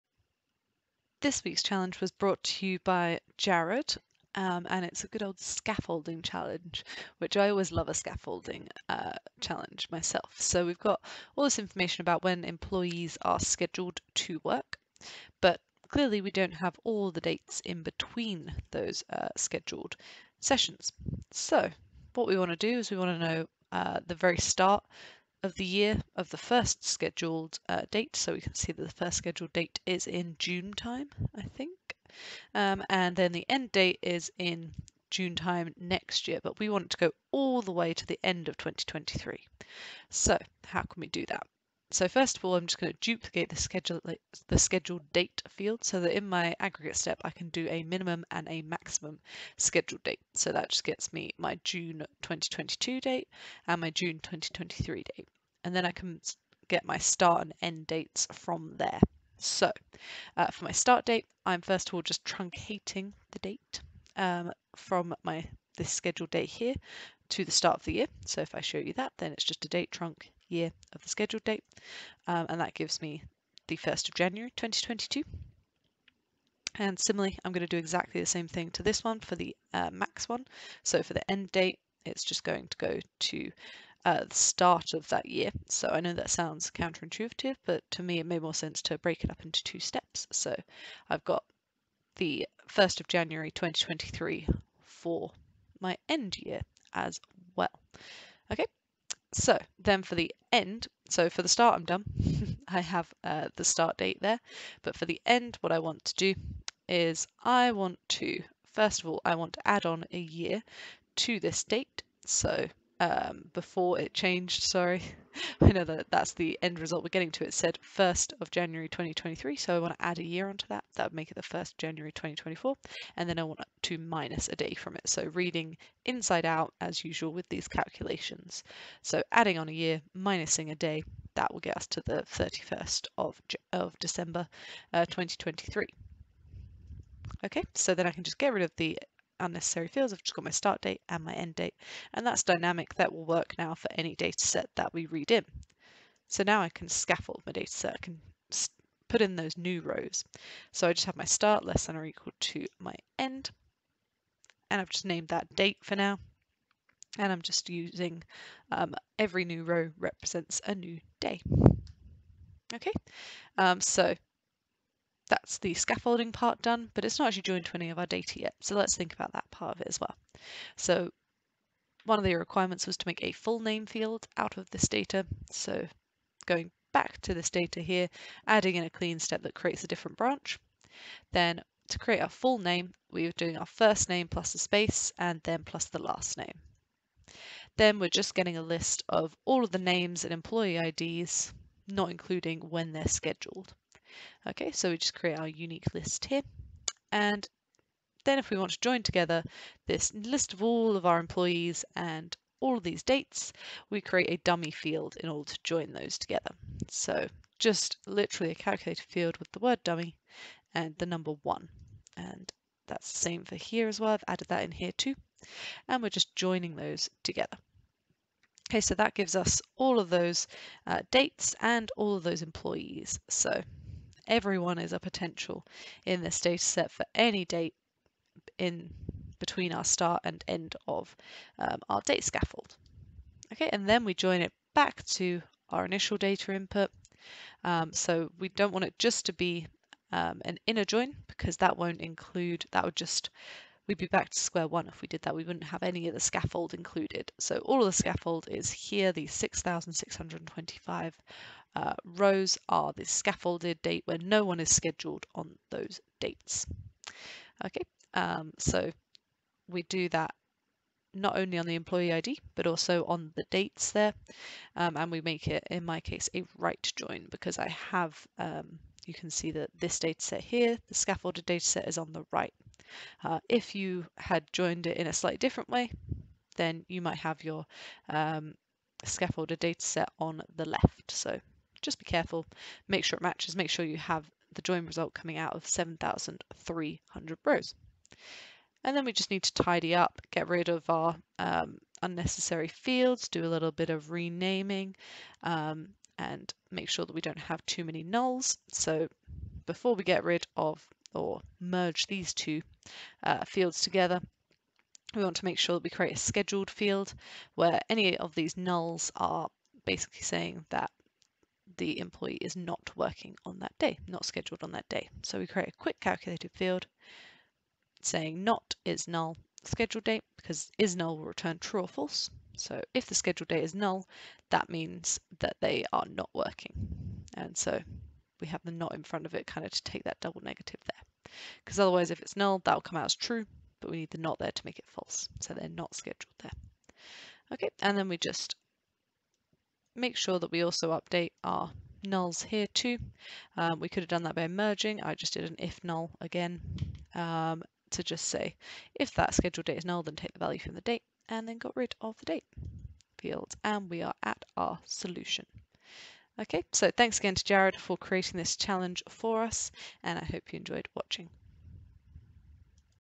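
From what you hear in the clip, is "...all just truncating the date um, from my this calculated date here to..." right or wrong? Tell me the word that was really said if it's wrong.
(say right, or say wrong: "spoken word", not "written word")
wrong: "scheduled", not "calculated".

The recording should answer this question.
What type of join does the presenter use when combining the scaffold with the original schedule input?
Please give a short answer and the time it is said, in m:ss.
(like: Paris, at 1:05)
right join, at 4:26.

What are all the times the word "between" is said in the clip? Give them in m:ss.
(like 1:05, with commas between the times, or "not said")
0:17, 3:49.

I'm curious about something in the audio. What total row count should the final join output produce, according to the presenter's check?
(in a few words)
7,300.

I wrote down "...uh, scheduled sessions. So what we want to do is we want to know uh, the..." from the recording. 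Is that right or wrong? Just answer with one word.
right.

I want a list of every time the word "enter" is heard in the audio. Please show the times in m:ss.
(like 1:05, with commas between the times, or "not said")
not said.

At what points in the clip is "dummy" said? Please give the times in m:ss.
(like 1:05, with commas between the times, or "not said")
3:24, 3:29.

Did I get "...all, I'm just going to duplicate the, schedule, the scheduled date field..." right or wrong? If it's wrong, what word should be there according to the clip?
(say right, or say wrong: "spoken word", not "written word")
right.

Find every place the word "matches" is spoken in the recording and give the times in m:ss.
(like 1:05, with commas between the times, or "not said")
4:43.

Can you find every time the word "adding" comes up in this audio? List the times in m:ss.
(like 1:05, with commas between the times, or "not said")
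2:09, 2:58.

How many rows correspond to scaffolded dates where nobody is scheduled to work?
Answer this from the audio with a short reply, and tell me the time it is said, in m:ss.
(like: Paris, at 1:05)
6,625, at 4:09.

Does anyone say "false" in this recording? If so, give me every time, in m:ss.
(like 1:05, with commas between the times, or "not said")
5:21, 5:34.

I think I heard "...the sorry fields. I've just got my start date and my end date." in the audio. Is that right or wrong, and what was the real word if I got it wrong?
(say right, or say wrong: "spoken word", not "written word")
wrong: "unnecessary", not "sorry".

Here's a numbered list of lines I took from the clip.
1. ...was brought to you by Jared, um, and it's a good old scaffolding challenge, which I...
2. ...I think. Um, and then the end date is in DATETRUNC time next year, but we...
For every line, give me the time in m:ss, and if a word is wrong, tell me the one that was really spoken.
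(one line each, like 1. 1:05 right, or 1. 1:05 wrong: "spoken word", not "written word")
1. 0:02 right
2. 0:31 wrong: "June", not "DATETRUNC".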